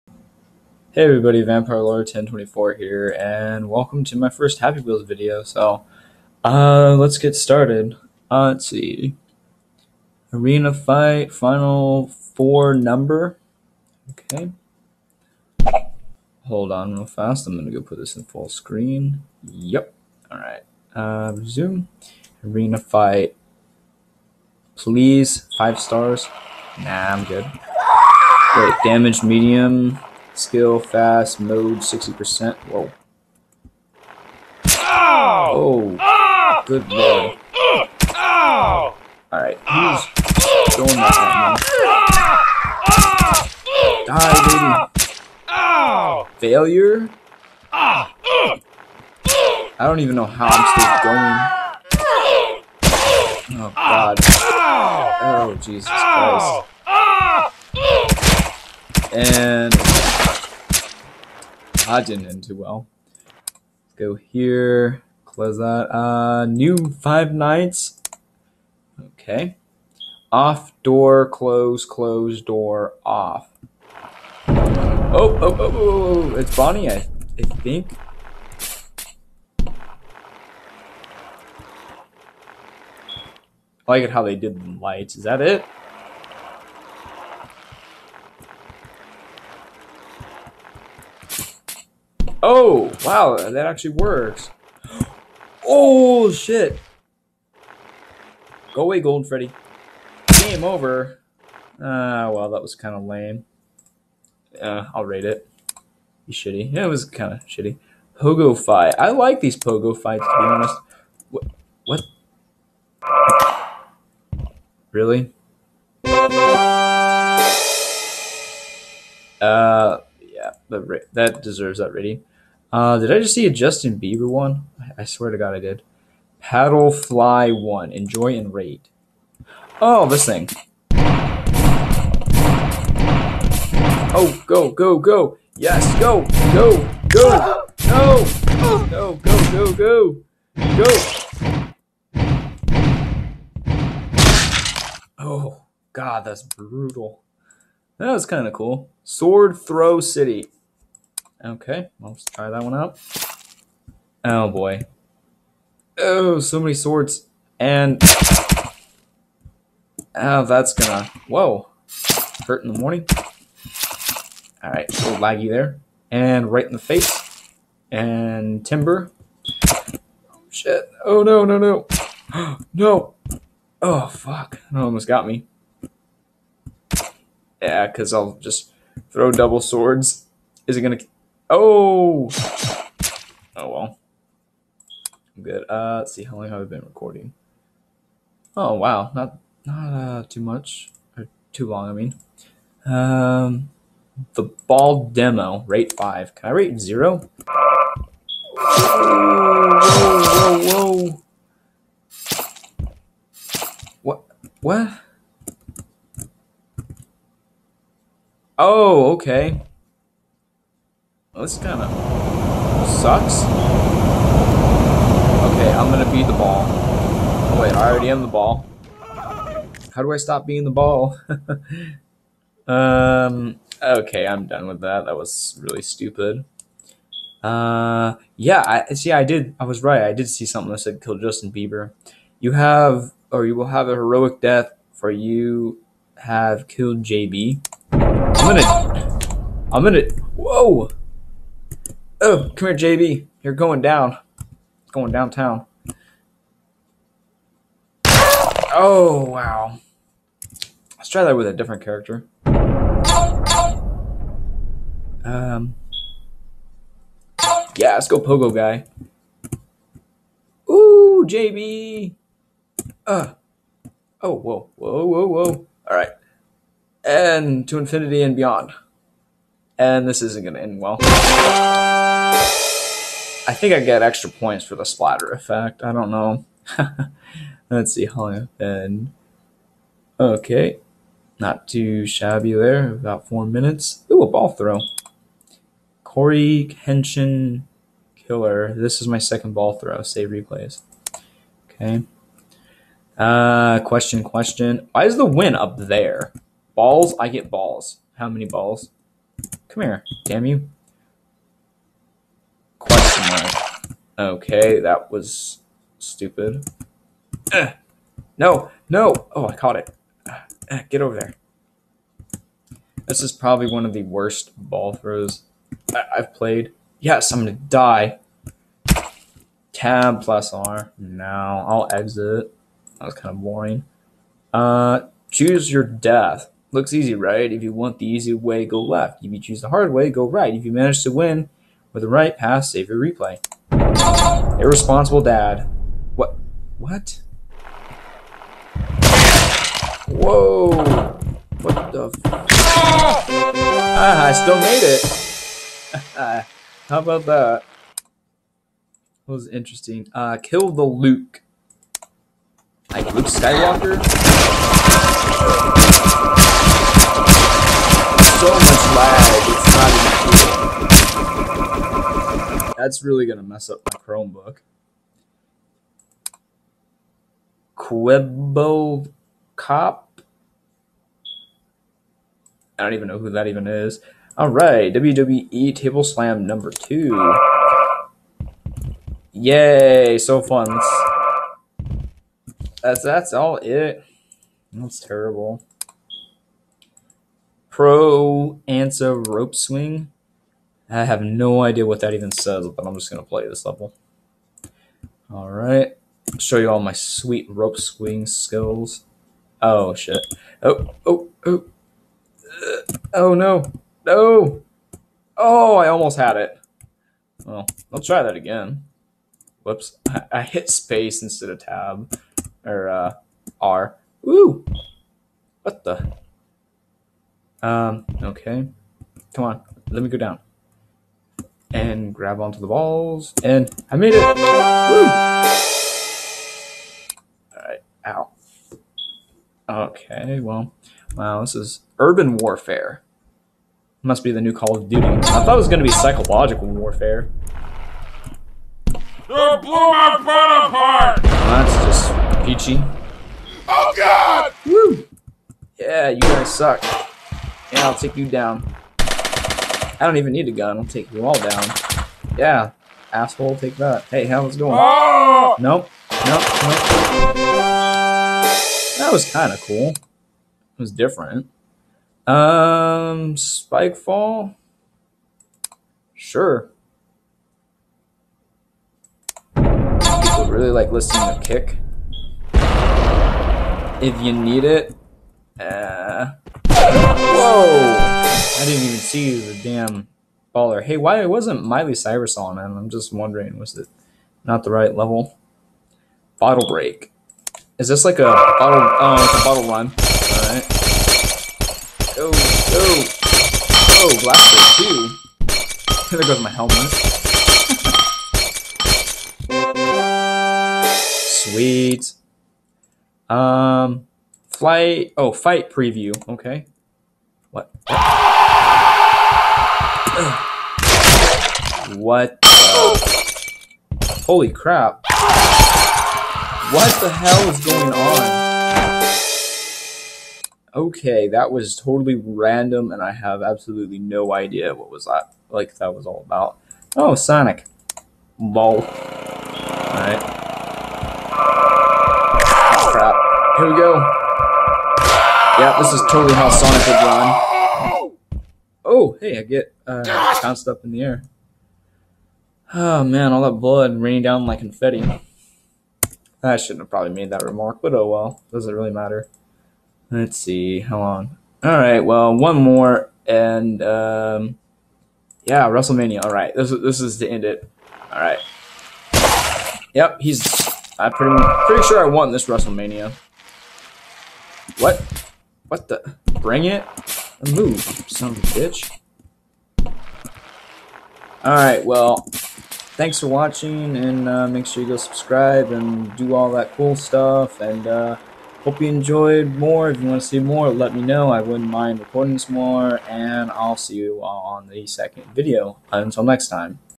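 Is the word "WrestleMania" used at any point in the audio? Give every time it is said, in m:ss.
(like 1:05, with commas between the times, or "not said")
9:15, 9:22.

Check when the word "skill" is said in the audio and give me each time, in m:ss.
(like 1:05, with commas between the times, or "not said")
0:30, 6:38.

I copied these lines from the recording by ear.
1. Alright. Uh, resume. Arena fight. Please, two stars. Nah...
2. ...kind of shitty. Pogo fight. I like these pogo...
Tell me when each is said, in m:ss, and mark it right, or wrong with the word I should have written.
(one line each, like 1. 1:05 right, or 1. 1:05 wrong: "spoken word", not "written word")
1. 0:20 wrong: "five", not "two"
2. 1:47 right.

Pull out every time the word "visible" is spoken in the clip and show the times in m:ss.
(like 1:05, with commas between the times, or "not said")
not said.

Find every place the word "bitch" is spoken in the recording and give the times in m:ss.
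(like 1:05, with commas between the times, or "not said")
9:28.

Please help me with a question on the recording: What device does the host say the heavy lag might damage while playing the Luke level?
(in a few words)
Chromebook.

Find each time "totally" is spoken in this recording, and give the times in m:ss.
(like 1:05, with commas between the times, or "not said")
8:41, 8:56.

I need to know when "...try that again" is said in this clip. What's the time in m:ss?
6:48.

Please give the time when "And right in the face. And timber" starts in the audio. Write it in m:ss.
2:46.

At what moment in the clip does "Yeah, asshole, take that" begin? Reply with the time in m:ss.
7:32.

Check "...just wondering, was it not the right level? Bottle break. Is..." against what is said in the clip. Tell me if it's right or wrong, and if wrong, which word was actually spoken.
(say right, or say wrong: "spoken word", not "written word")
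right.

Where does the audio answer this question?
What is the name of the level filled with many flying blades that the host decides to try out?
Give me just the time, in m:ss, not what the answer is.
2:29.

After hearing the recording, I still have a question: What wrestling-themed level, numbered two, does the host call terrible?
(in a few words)
WWE Table Slam.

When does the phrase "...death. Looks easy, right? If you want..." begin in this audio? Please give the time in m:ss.
5:25.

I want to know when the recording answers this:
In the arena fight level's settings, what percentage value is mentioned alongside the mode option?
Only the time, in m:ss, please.
0:31.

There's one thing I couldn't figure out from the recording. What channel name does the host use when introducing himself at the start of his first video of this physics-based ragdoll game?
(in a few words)
Vampire Lord 1024.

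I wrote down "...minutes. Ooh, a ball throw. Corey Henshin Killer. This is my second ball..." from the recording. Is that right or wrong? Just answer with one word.
right.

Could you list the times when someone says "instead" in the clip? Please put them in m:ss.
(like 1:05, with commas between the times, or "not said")
6:51.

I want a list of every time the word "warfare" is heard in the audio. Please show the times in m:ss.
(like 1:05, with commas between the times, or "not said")
7:12, 7:16.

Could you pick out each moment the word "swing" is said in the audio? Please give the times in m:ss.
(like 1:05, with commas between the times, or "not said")
6:29, 6:37.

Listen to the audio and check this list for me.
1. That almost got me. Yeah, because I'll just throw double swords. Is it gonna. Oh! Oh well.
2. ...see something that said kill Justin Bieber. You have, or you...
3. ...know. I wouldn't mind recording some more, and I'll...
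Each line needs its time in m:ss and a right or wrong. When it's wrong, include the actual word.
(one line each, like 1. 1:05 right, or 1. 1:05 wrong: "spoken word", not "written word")
1. 2:54 right
2. 3:50 right
3. 9:41 right.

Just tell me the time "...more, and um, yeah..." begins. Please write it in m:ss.
9:12.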